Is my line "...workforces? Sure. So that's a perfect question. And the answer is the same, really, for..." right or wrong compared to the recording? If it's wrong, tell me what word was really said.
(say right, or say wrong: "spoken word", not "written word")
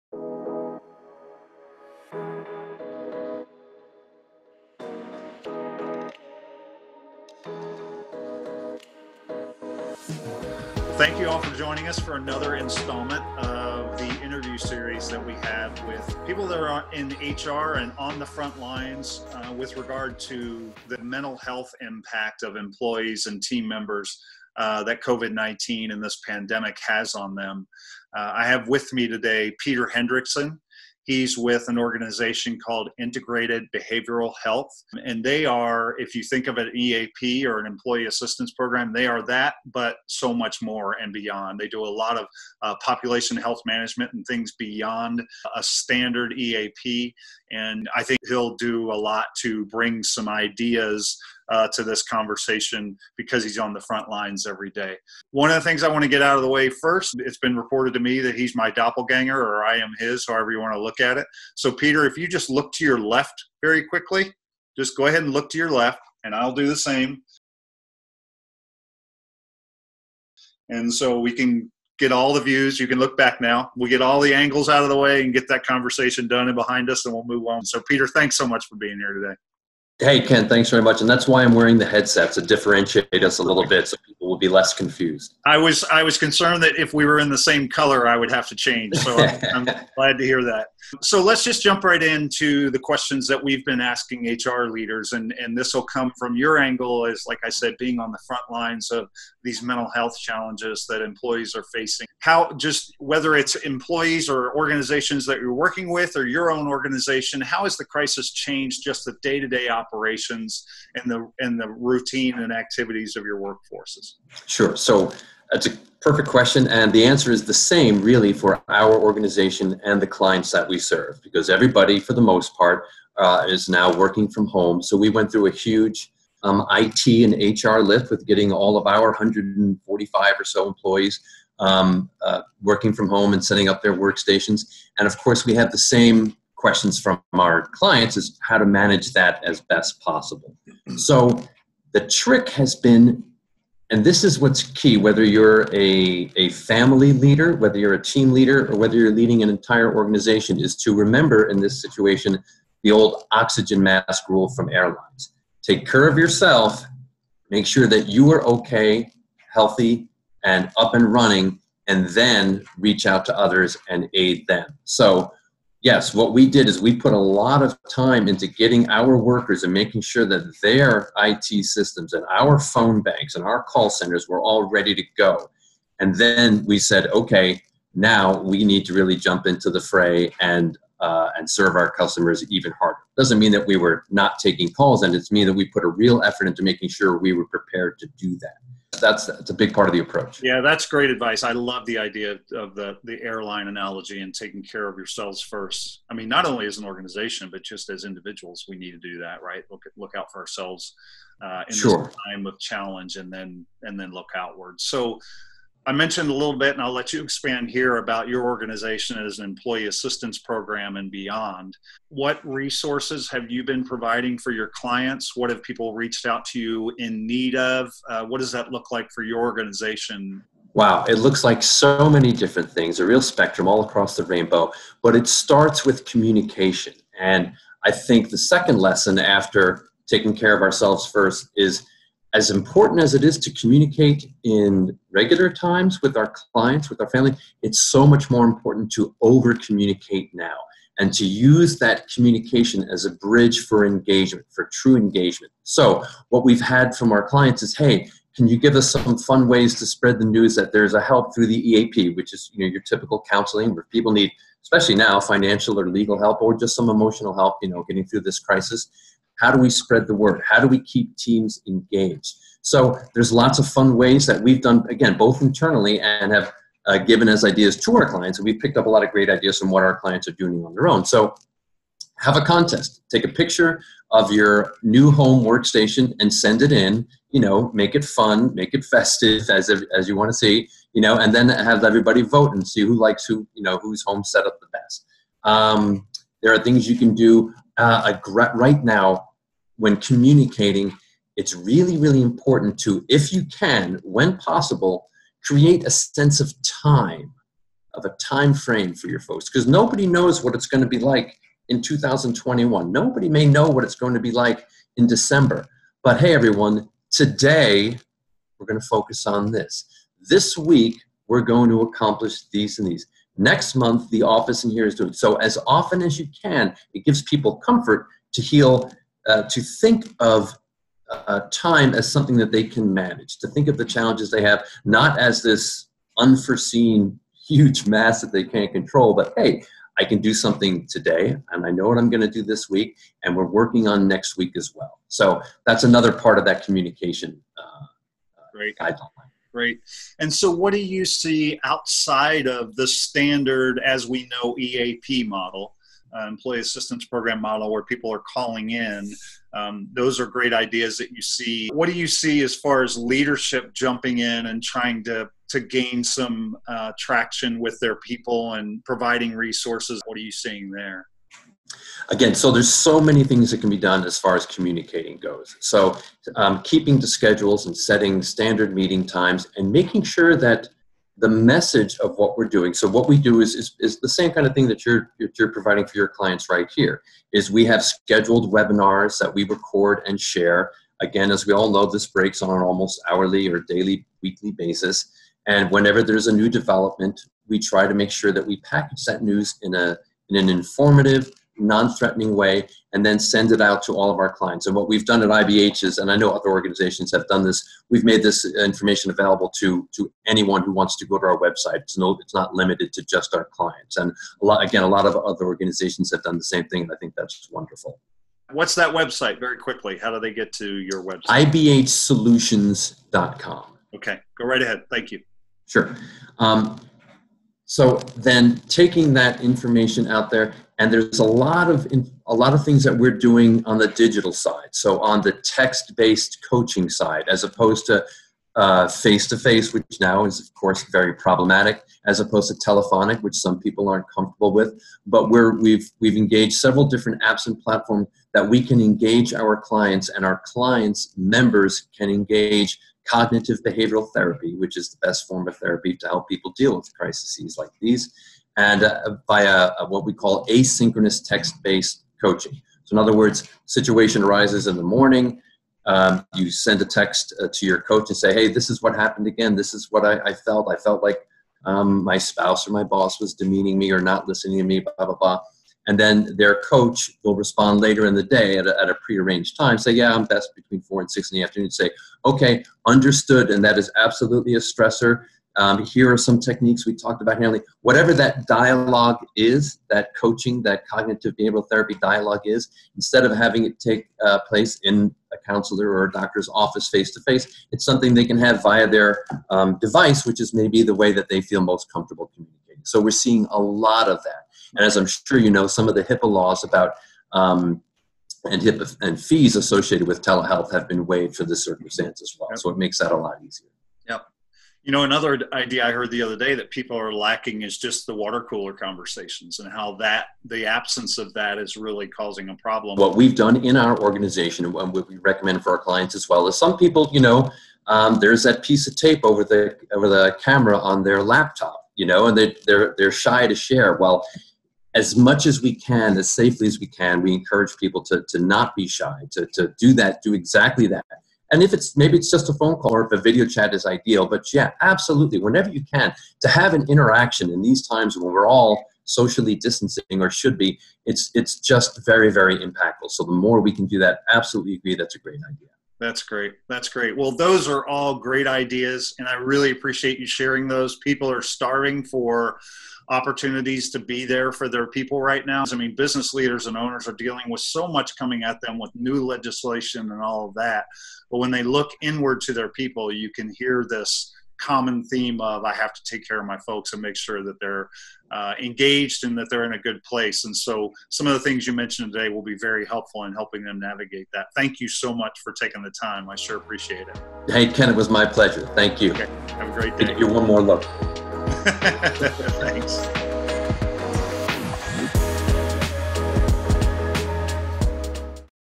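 right.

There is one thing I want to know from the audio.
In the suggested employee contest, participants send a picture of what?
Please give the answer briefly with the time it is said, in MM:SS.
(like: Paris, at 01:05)
new home workstation, at 04:34.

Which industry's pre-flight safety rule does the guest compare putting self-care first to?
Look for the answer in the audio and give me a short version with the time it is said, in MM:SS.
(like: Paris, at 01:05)
airlines, at 02:34.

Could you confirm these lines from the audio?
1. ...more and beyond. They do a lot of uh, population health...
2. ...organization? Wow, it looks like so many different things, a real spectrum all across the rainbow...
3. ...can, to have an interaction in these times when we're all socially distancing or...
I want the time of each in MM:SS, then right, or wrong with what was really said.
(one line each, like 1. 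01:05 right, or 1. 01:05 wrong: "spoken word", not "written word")
1. 00:40 right
2. 03:39 right
3. 08:55 right.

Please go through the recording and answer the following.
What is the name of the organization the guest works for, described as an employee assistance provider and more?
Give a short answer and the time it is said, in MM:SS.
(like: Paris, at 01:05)
Integrated Behavioral Health, at 00:32.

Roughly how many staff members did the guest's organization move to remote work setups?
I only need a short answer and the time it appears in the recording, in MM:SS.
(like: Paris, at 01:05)
145, at 02:09.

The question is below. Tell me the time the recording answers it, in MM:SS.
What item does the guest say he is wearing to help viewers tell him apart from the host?
01:21.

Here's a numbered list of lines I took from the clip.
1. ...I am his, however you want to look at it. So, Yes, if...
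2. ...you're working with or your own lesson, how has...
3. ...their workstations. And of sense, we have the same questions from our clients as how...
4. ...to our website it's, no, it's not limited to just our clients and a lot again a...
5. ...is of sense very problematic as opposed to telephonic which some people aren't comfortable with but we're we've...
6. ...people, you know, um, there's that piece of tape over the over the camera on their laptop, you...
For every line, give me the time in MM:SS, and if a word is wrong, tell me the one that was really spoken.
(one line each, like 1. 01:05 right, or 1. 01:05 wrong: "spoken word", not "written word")
1. 00:59 wrong: "Peter", not "Yes"
2. 01:45 wrong: "organization", not "lesson"
3. 02:13 wrong: "course", not "sense"
4. 06:41 right
5. 07:10 wrong: "course", not "sense"
6. 08:36 right.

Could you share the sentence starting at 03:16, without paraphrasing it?
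I mean, not only as an organization, but just as individuals, we need to do that, right?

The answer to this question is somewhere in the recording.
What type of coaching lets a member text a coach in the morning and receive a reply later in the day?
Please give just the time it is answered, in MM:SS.
07:30.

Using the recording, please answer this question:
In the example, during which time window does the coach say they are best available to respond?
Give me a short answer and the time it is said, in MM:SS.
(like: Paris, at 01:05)
4 to 6 in the afternoon, at 07:50.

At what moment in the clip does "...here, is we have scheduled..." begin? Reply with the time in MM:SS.
06:16.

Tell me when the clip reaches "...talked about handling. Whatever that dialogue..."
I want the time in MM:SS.
07:56.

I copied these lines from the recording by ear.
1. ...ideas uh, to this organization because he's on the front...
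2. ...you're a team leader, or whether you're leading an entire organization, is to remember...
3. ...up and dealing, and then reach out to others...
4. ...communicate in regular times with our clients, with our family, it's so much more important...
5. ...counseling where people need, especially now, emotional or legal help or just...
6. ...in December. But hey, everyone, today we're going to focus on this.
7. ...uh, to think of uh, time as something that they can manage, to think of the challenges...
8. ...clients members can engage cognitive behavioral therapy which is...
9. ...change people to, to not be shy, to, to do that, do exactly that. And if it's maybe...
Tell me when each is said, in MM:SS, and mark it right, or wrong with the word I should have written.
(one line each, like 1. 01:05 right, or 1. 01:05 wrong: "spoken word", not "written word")
1. 00:50 wrong: "conversation", not "organization"
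2. 02:27 right
3. 02:40 wrong: "running", not "dealing"
4. 03:53 right
5. 04:13 wrong: "financial", not "emotional"
6. 05:04 right
7. 05:19 right
8. 07:20 right
9. 08:47 wrong: "encourage", not "change".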